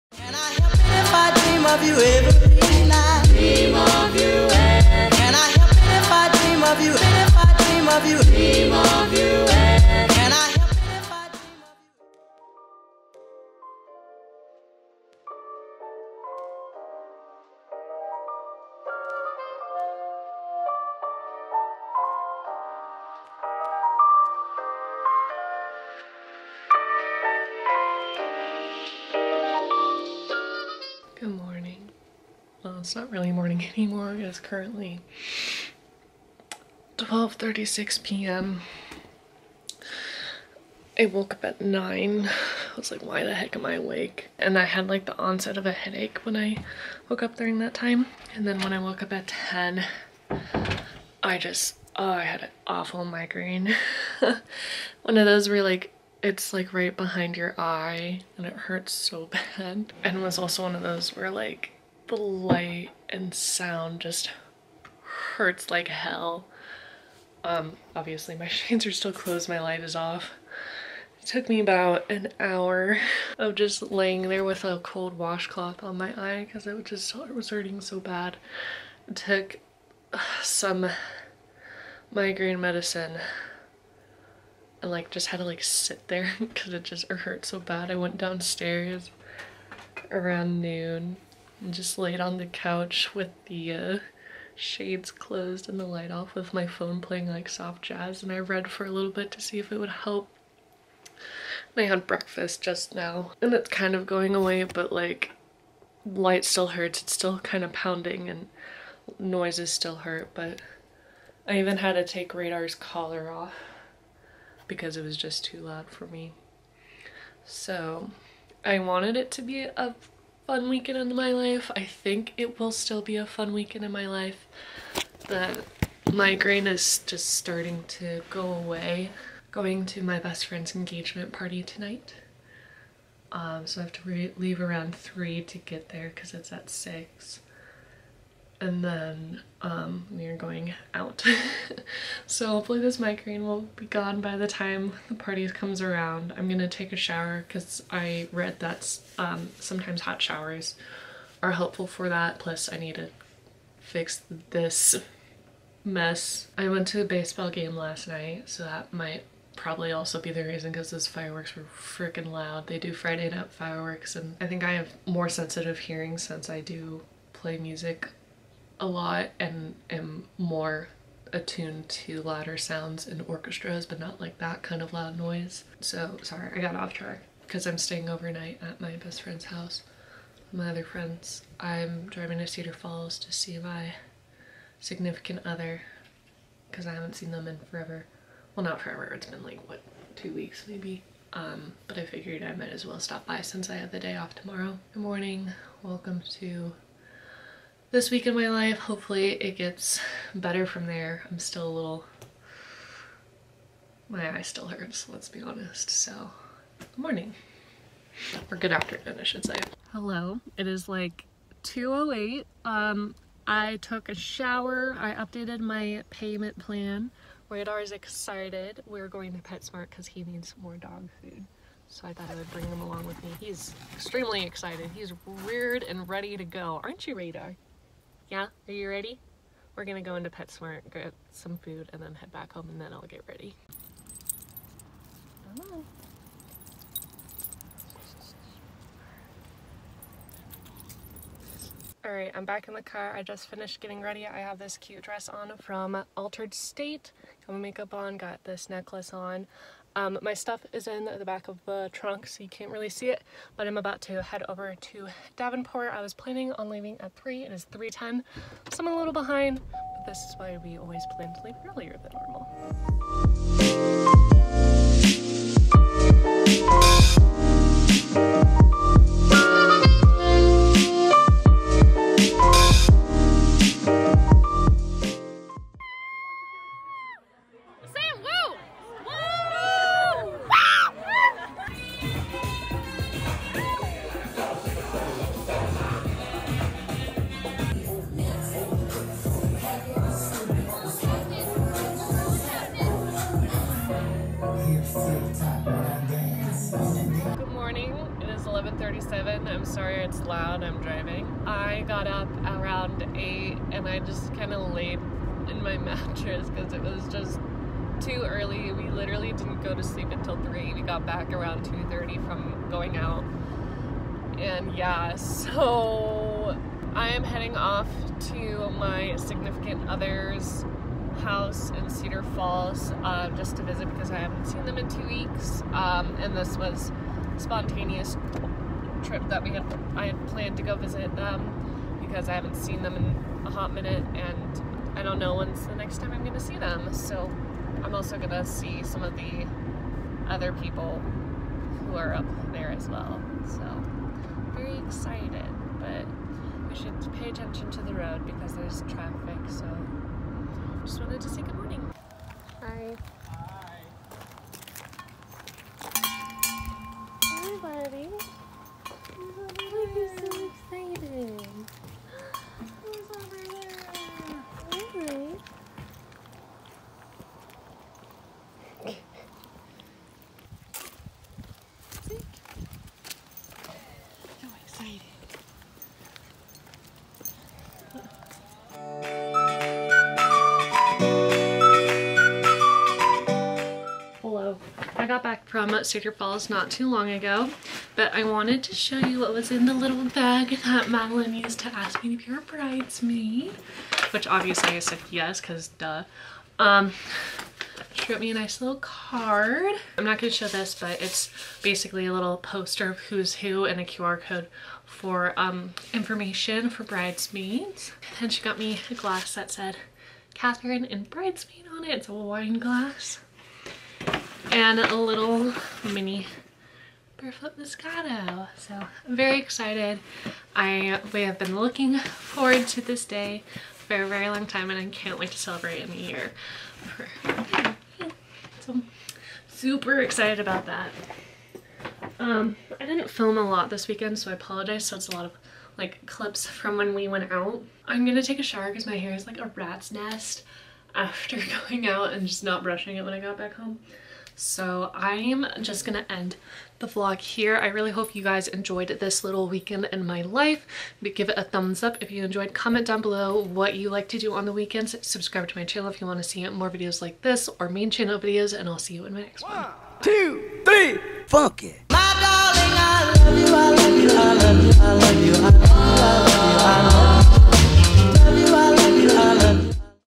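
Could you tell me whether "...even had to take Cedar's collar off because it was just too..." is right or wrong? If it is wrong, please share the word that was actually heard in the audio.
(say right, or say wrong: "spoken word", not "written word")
wrong: "Radar", not "Cedar".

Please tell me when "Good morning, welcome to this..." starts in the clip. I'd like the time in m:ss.
3:14.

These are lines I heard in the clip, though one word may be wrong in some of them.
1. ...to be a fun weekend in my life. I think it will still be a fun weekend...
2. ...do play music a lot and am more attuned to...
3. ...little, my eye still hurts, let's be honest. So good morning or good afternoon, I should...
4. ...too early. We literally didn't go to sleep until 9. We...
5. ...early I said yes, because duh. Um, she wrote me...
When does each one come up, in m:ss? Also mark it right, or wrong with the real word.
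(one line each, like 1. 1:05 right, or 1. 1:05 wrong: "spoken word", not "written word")
1. 1:59 right
2. 2:46 right
3. 3:21 right
4. 5:08 wrong: "3", not "9"
5. 6:34 wrong: "obviously", not "early".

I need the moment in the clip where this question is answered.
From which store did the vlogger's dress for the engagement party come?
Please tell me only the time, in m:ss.
4:06.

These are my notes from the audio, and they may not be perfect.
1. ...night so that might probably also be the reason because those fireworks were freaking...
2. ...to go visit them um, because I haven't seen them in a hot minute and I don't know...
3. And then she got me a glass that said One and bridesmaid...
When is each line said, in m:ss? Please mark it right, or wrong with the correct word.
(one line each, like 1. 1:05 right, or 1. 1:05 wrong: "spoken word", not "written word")
1. 2:38 right
2. 5:30 right
3. 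6:48 wrong: "Catherine", not "One".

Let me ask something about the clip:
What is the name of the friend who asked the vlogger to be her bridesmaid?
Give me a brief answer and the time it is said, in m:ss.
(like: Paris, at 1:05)
Madeline, at 6:30.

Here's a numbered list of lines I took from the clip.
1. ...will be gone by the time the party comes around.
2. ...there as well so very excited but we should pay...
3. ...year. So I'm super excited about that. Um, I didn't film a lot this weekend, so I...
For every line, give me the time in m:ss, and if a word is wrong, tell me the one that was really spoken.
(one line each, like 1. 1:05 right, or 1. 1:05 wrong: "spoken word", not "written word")
1. 2:23 right
2. 5:42 right
3. 7:05 right.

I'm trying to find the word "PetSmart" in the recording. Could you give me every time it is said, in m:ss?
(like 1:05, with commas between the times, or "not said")
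3:39, 3:50.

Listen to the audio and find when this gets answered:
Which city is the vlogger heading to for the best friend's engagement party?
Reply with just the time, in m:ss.
4:15.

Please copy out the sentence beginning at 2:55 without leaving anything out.
So sorry, I got off track because I'm staying overnight at my best friend's house.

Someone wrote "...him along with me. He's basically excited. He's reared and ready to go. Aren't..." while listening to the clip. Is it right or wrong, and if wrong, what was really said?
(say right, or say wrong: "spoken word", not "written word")
wrong: "extremely", not "basically".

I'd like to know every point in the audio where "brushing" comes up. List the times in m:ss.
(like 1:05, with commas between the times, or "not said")
7:22.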